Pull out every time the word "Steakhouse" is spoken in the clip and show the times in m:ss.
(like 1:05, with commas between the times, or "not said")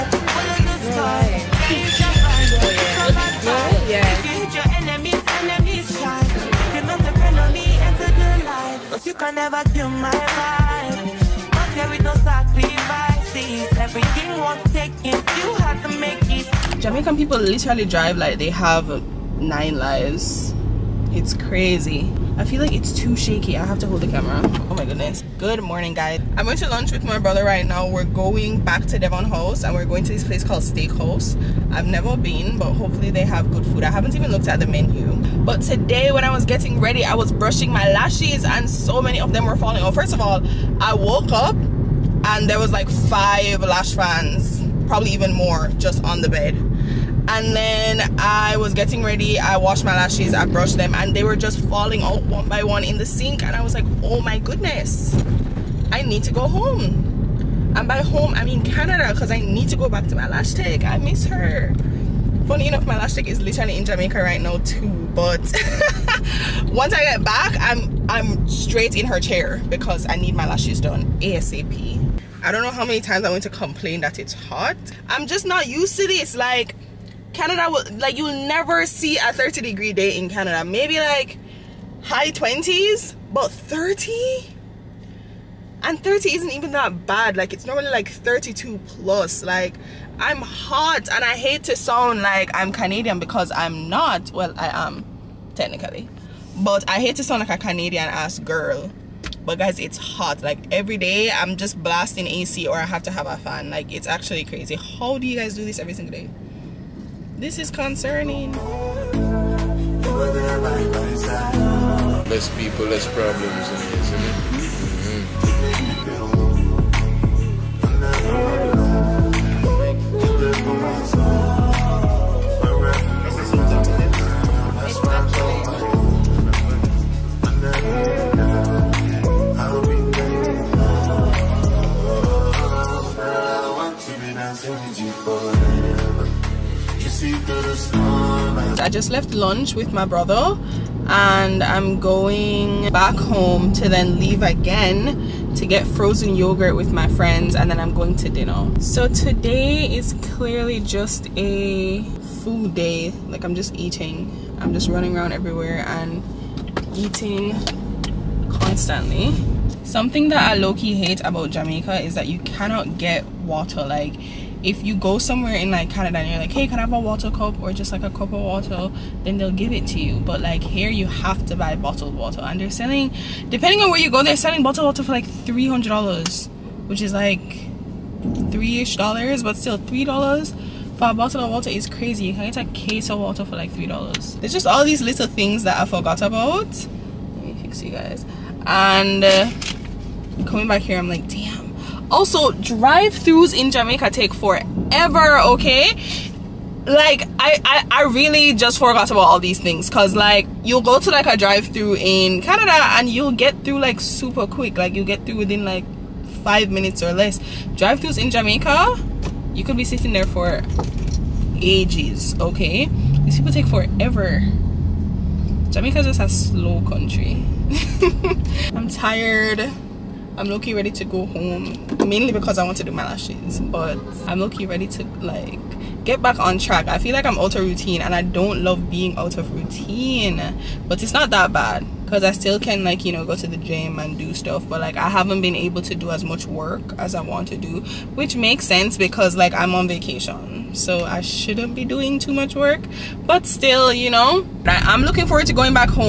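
0:30.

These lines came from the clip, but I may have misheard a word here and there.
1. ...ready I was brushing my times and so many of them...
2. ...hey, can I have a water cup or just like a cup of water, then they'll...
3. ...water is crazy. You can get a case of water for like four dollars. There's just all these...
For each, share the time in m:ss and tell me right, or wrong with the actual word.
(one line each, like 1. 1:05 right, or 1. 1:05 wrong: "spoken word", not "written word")
1. 0:36 wrong: "lashes", not "times"
2. 2:46 right
3. 3:01 wrong: "three", not "four".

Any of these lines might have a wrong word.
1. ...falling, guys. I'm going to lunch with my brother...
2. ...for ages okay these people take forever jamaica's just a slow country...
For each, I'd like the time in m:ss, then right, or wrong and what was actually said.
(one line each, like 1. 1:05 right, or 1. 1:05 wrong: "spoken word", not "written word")
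1. 0:25 wrong: "morning", not "falling"
2. 3:30 right.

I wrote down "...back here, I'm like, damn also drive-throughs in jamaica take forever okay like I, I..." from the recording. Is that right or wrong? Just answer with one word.
right.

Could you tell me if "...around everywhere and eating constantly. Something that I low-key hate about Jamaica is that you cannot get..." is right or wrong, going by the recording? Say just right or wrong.
right.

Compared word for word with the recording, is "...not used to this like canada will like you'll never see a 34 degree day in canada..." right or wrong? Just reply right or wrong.
wrong.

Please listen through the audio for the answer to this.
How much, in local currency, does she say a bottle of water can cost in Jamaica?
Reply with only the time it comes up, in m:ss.
2:55.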